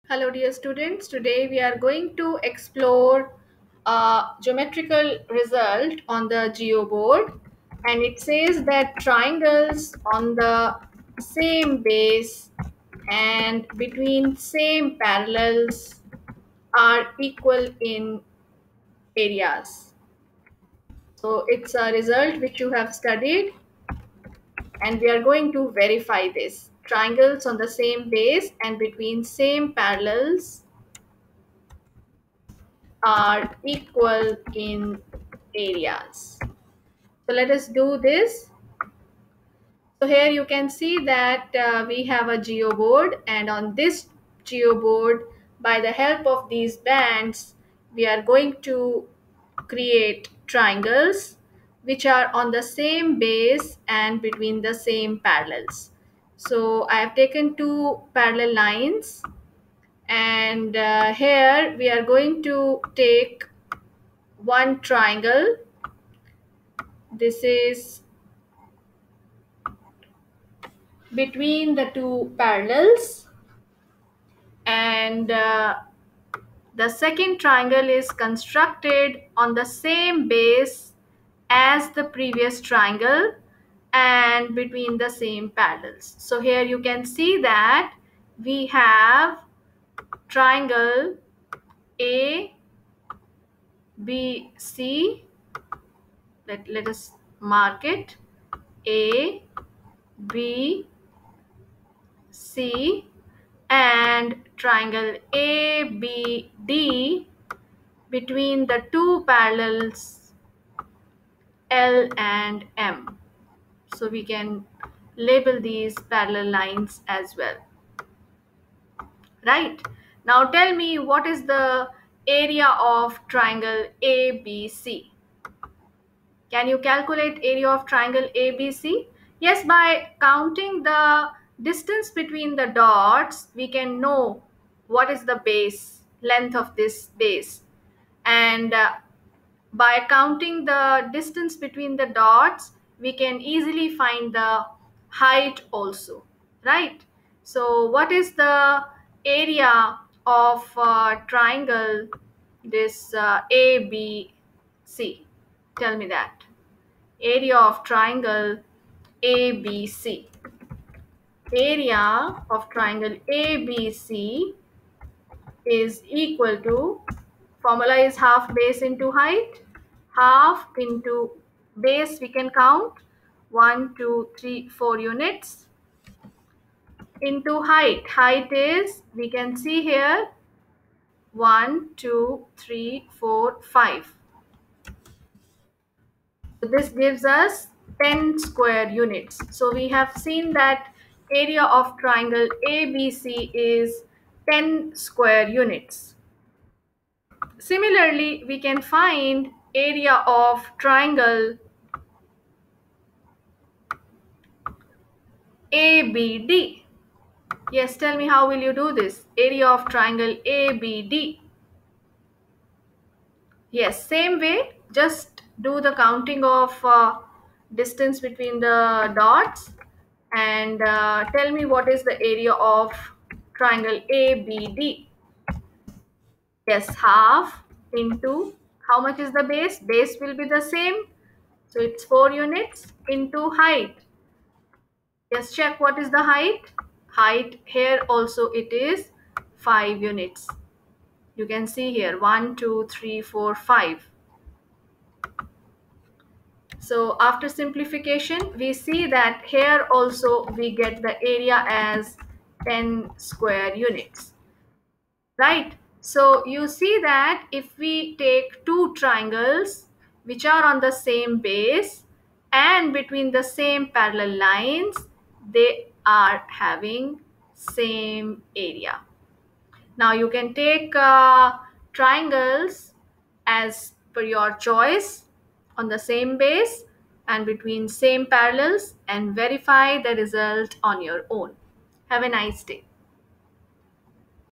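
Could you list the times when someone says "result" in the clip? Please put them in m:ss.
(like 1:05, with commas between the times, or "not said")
0:05, 0:21, 4:40.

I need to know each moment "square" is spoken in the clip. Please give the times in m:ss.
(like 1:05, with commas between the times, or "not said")
3:08, 3:14, 4:13.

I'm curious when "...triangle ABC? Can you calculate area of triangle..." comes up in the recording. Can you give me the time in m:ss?
2:03.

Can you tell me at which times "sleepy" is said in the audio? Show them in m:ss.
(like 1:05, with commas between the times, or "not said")
not said.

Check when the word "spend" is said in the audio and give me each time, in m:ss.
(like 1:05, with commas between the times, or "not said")
not said.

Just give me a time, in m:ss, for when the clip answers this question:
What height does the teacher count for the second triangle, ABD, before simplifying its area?
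3:59.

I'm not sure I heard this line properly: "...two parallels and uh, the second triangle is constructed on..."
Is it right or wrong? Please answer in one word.
right.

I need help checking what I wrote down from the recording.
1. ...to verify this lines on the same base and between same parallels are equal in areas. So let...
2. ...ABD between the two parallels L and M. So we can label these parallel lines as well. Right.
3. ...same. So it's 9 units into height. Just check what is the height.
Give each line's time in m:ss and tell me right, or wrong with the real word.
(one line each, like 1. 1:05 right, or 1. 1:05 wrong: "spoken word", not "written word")
1. 0:25 wrong: "triangles", not "lines"
2. 1:45 right
3. 3:50 wrong: "4", not "9".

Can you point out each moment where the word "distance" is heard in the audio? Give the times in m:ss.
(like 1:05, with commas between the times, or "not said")
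2:11, 2:21, 3:37.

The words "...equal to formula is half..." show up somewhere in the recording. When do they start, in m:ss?
2:46.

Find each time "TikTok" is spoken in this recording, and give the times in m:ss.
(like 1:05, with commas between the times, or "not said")
not said.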